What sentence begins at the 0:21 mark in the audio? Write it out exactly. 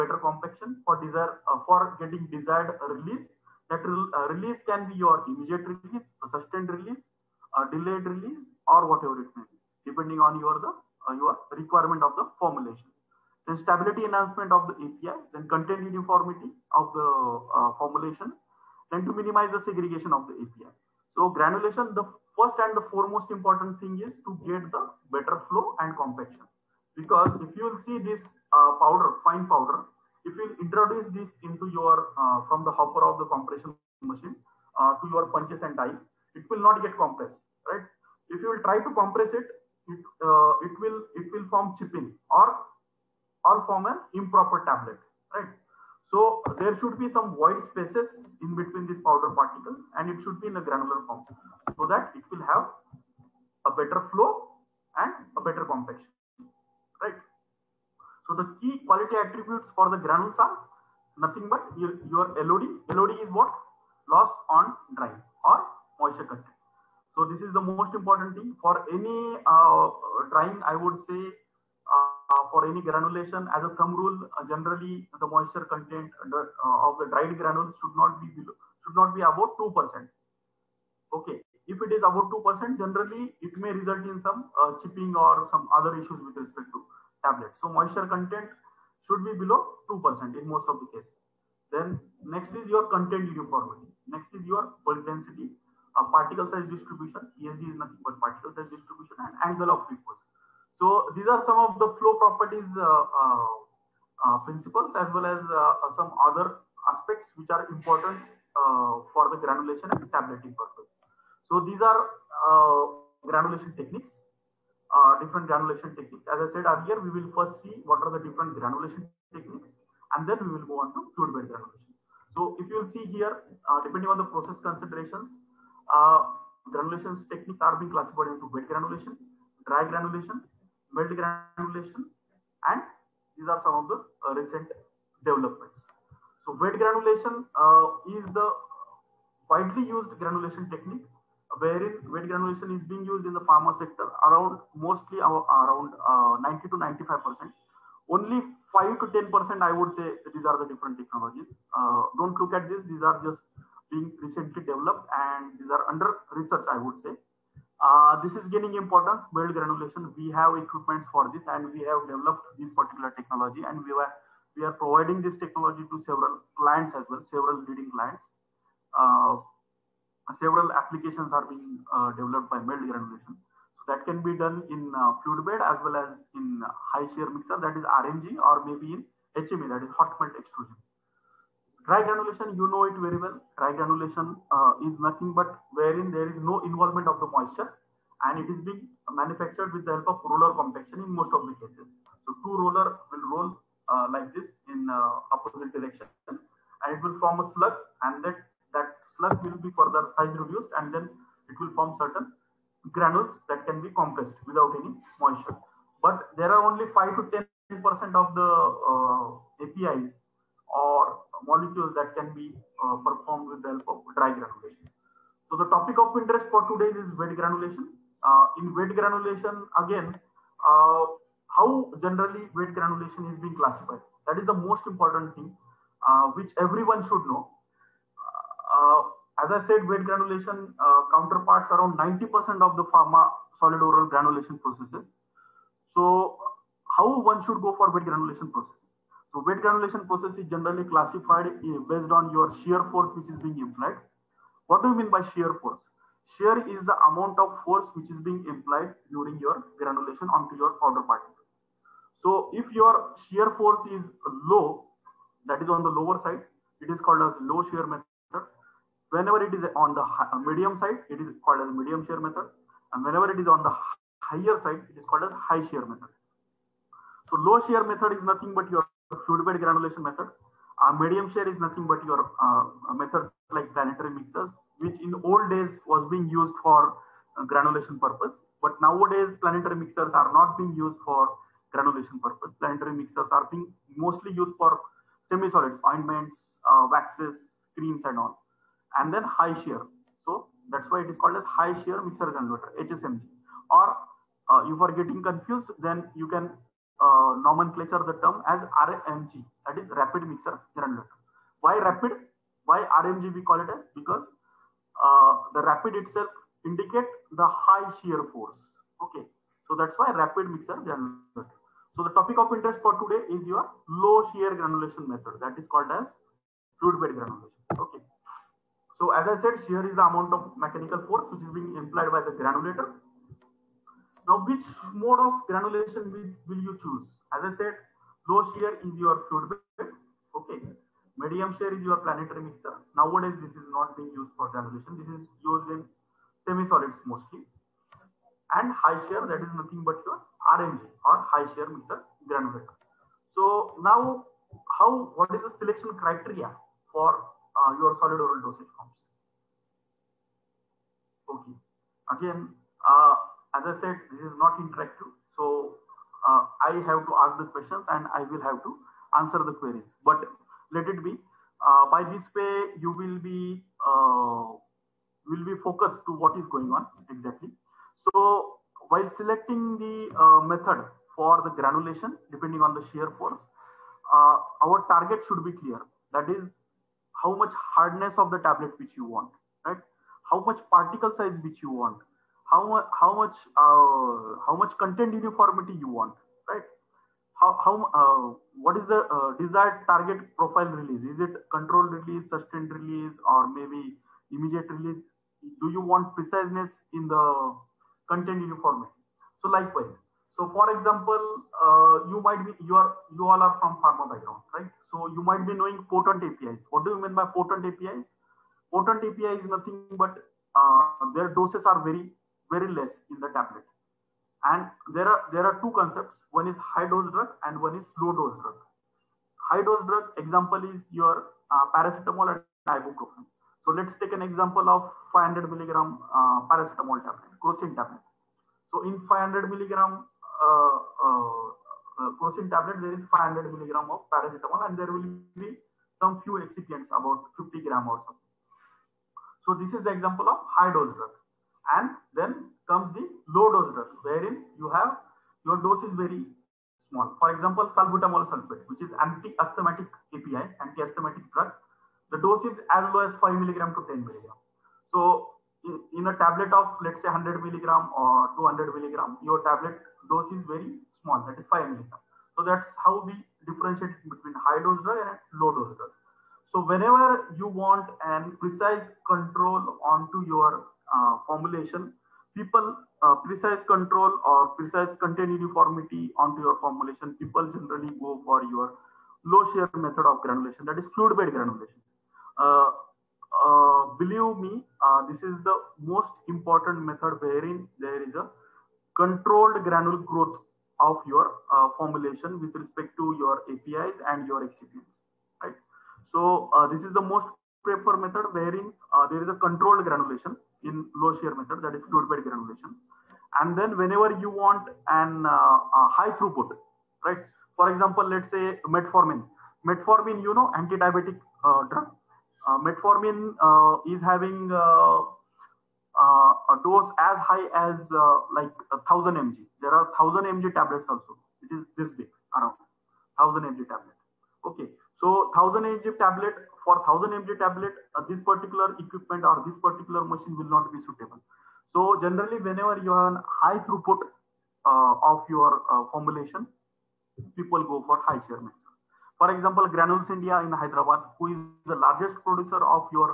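So granulation, the first and the foremost important thing is to get the better flow and compaction.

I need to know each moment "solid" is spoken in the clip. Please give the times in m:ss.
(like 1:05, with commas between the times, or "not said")
3:53, 4:45, 5:36, 5:47.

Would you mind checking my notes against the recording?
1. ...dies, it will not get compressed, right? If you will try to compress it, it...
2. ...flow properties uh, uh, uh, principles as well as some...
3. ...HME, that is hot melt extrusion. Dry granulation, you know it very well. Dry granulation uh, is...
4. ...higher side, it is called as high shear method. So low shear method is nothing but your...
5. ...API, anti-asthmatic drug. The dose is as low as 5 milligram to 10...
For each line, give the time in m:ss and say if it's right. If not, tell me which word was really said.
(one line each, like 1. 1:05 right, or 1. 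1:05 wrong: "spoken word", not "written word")
1. 0:35 right
2. 1:42 right
3. 2:59 right
4. 4:24 right
5. 7:30 right.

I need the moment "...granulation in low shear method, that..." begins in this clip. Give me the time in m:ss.
8:19.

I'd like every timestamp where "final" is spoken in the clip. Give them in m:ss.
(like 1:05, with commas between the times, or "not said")
not said.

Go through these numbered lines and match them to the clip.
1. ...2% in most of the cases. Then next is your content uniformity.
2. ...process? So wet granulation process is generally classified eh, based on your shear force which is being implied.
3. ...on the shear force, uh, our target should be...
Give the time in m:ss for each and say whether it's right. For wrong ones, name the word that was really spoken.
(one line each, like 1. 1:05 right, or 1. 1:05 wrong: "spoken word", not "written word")
1. 1:29 right
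2. 3:58 right
3. 6:12 right.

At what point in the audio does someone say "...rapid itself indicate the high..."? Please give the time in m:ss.
5:05.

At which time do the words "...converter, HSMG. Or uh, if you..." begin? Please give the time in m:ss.
4:52.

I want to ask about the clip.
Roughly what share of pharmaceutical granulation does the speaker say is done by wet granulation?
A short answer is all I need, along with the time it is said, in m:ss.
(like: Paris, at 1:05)
90 to 95 percent, at 2:26.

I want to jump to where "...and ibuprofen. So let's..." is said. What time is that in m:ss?
7:02.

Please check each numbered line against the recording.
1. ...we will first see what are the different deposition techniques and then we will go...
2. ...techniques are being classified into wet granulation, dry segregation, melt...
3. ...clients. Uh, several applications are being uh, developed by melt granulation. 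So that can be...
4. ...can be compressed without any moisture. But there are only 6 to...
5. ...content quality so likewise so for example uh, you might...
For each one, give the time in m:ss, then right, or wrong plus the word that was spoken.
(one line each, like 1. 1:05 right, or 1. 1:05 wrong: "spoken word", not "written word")
1. 1:56 wrong: "granulation", not "deposition"
2. 2:07 wrong: "granulation", not "segregation"
3. 2:47 right
4. 3:23 wrong: "5", not "6"
5. 6:38 wrong: "uniformity", not "quality".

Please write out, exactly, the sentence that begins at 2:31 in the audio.
Uh, don't look at this, these are just being recently developed and these are under research, I would say.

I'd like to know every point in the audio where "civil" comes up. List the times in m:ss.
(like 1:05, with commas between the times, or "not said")
not said.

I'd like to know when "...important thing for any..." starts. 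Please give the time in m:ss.
1:07.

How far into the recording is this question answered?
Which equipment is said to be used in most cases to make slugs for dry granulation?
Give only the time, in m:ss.
3:10.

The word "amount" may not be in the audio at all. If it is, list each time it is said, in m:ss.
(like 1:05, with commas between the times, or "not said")
4:07, 5:20.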